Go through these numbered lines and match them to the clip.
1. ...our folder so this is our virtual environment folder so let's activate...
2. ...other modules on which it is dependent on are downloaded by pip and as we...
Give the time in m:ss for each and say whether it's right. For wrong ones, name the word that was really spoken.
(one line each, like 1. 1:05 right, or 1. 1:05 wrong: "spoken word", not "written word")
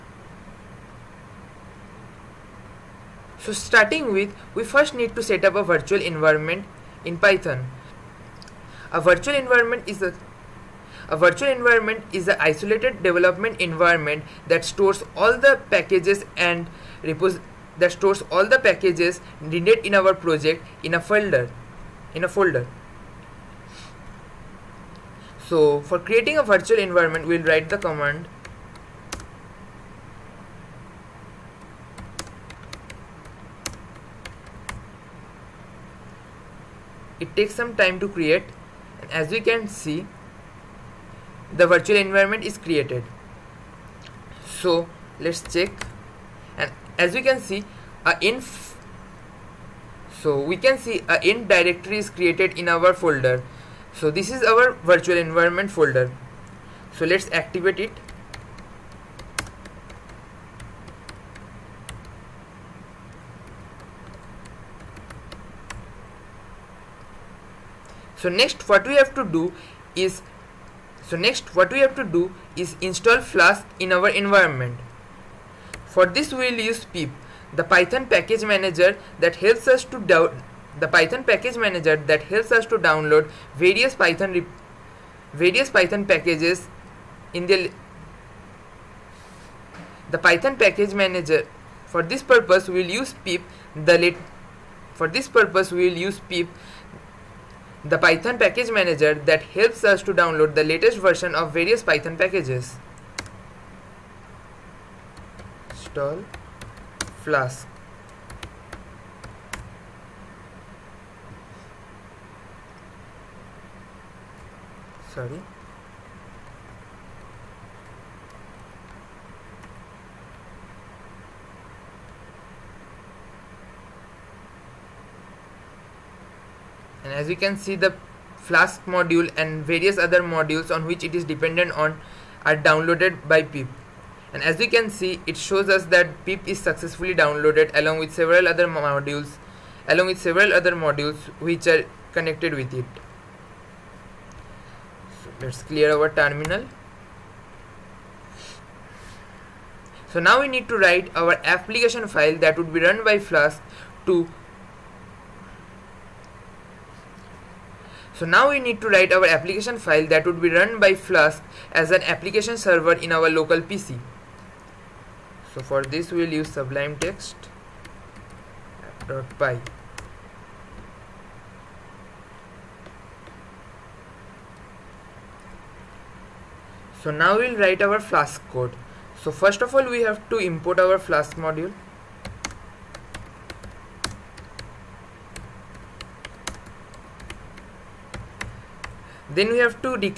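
1. 0:52 right
2. 2:10 right.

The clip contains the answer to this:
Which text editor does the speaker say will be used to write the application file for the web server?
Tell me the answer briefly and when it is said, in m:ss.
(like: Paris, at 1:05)
Sublime Text, at 2:46.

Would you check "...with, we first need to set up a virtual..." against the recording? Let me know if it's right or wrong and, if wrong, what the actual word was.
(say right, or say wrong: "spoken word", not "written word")
right.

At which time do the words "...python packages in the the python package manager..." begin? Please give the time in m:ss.
1:25.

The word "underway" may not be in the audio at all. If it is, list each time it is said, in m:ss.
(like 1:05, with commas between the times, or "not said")
not said.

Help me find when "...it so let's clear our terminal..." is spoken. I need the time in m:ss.
2:22.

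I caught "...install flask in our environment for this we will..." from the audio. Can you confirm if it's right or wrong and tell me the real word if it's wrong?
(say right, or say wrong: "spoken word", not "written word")
right.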